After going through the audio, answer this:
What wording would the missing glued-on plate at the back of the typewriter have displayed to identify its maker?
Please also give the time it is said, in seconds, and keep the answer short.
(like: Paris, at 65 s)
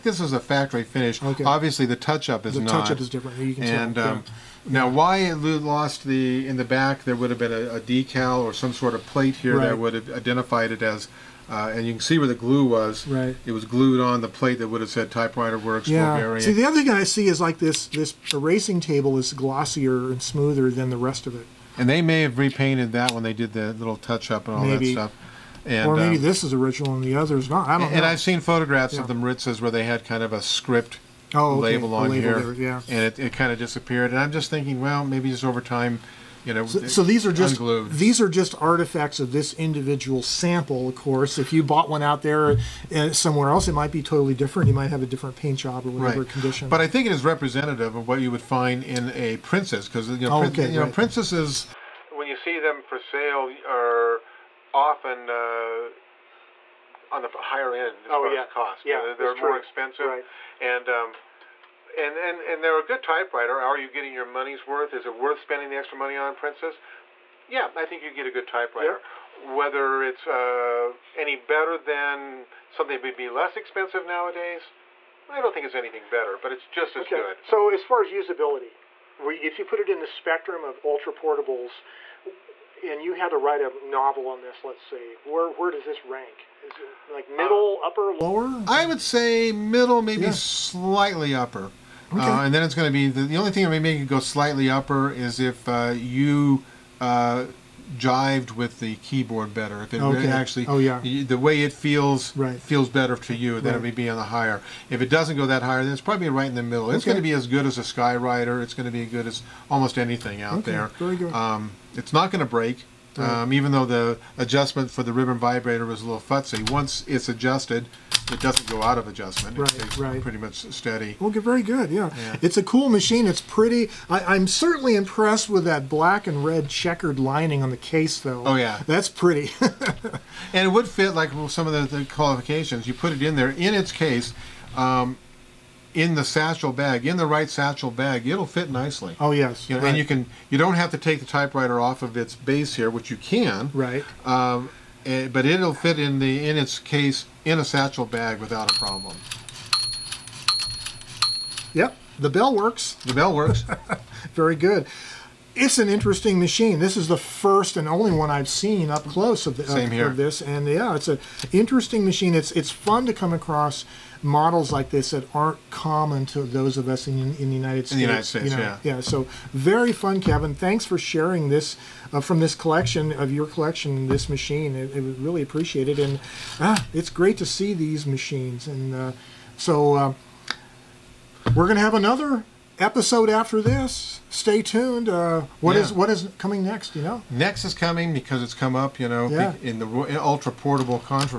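Typewriter Works, at 15 s.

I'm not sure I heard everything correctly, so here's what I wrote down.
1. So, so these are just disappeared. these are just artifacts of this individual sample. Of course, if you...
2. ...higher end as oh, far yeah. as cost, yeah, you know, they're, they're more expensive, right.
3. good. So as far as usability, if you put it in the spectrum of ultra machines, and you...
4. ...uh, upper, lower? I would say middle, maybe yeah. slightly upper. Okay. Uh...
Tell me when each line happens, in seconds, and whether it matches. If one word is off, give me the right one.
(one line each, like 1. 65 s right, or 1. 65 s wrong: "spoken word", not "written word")
1. 36 s wrong: "unglued", not "disappeared"
2. 57 s right
3. 77 s wrong: "portables", not "machines"
4. 87 s right.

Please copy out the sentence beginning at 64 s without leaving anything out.
Is it worth spending the extra money on, Princess?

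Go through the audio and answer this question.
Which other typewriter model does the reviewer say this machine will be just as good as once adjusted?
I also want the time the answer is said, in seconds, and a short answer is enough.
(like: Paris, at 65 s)
Skyriter, at 107 s.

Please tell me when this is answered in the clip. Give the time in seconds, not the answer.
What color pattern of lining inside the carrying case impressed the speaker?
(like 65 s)
125 s.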